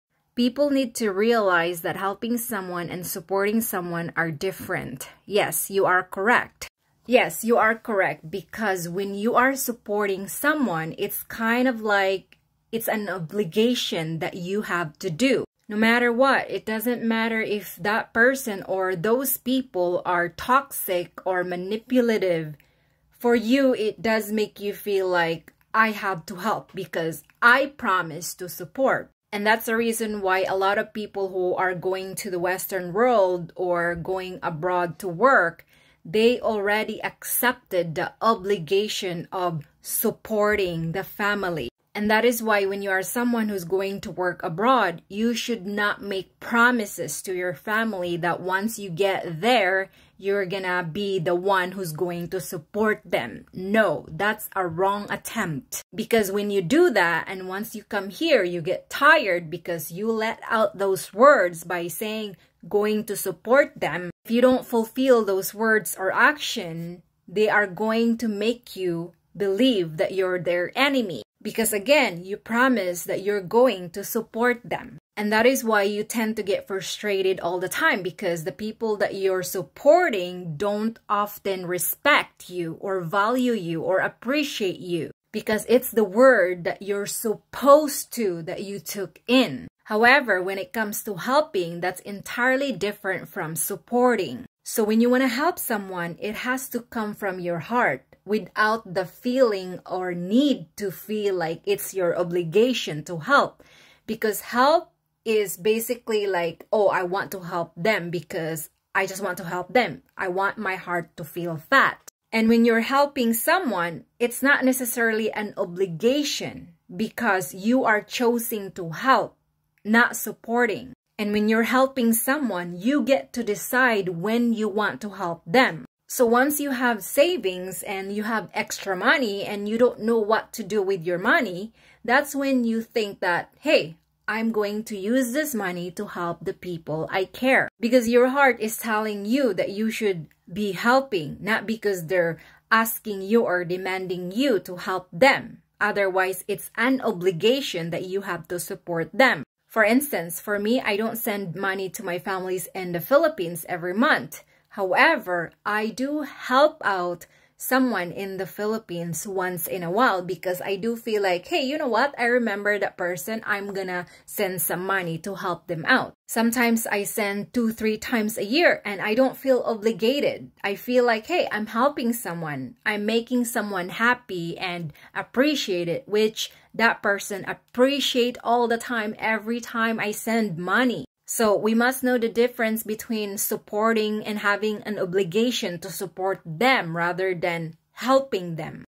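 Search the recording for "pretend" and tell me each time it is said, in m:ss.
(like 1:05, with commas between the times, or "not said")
not said.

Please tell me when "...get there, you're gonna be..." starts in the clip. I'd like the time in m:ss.
0:48.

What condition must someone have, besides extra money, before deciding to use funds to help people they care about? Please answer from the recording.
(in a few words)
savings.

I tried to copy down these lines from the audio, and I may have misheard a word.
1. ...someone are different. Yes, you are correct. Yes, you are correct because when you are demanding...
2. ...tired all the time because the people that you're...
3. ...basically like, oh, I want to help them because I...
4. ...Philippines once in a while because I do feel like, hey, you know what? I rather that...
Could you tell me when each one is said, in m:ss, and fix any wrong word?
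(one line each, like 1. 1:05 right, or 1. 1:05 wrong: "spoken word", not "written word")
1. 0:03 wrong: "supporting", not "demanding"
2. 1:16 wrong: "frustrated", not "tired"
3. 1:45 right
4. 2:38 wrong: "remember", not "rather".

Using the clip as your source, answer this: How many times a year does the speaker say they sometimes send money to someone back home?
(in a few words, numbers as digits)
2 or 3.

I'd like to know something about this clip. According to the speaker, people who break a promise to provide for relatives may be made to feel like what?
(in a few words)
their enemy.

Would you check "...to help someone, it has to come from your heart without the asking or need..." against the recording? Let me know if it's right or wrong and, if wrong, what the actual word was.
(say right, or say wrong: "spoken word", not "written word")
wrong: "feeling", not "asking".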